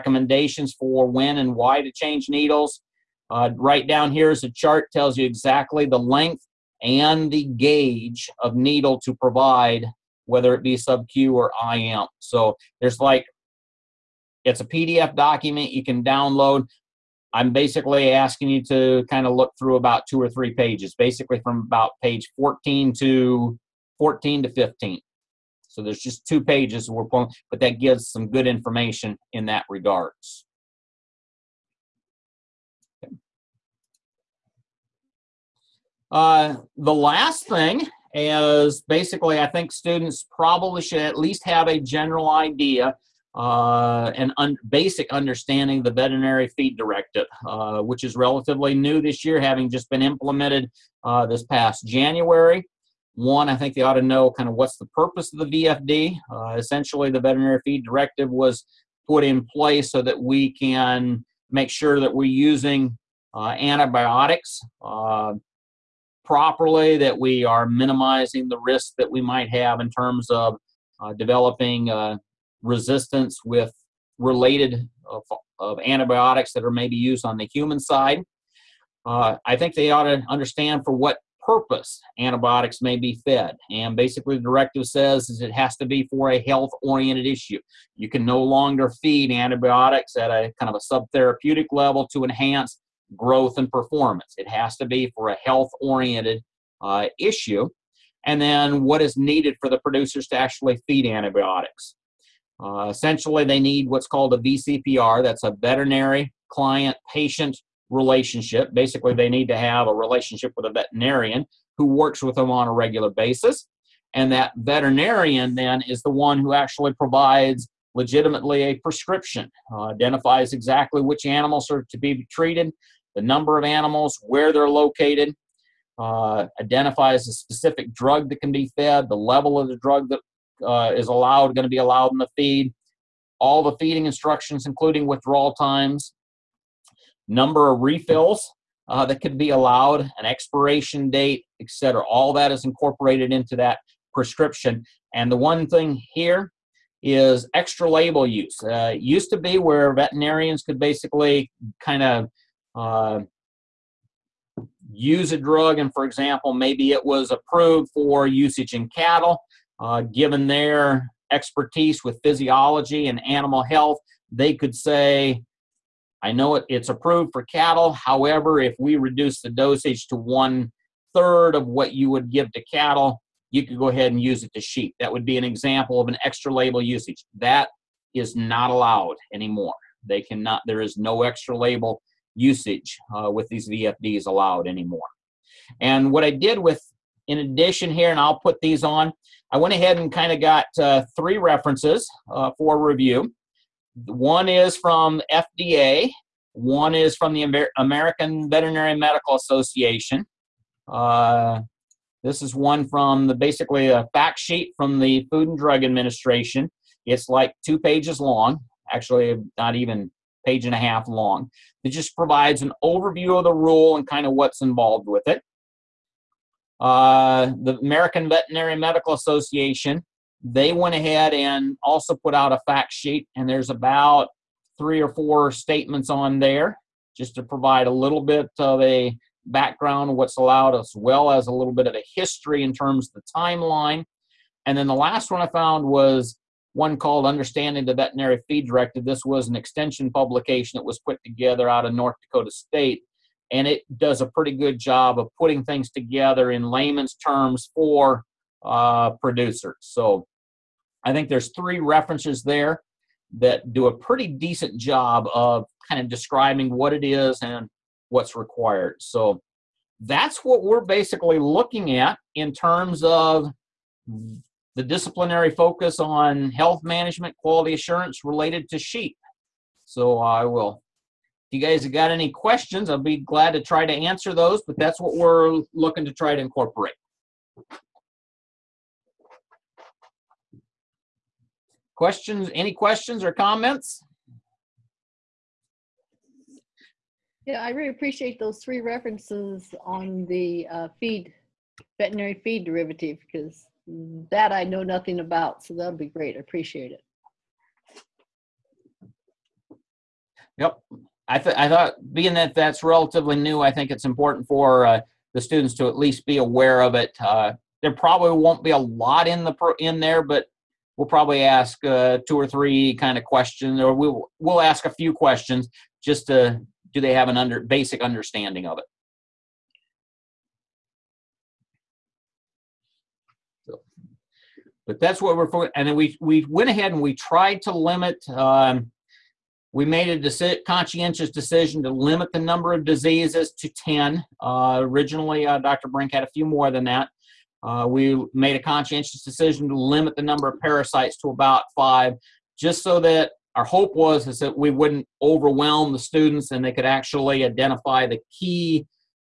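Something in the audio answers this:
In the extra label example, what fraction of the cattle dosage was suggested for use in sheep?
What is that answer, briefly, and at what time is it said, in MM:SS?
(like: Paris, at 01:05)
one third, at 02:50.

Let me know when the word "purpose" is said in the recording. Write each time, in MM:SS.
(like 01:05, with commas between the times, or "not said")
00:54, 01:21.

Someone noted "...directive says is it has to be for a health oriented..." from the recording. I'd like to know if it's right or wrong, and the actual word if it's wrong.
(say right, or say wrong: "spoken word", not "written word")
right.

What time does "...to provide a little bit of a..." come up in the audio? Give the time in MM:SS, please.
03:47.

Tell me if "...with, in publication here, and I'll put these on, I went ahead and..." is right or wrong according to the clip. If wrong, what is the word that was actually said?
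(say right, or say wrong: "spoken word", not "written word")
wrong: "addition", not "publication".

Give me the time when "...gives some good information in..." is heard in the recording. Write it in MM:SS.
00:27.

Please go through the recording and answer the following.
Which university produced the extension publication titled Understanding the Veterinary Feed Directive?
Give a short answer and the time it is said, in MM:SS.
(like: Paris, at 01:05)
North Dakota State, at 04:01.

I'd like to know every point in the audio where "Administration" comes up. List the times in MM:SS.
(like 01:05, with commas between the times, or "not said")
03:25.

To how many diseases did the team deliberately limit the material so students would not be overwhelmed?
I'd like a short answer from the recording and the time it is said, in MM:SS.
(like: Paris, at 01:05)
10, at 05:33.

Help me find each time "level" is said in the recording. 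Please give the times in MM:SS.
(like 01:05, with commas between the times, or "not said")
01:31, 02:09.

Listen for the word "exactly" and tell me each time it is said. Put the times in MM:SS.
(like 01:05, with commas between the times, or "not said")
00:05, 02:00.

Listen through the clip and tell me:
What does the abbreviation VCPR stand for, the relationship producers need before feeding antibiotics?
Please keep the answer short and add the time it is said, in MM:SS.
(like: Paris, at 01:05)
veterinary client patient relationship, at 01:45.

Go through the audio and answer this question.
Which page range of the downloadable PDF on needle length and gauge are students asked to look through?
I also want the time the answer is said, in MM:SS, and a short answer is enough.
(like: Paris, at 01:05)
pages 14 to 15, at 00:22.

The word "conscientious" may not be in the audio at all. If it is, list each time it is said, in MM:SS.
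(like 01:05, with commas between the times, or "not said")
05:30, 05:38.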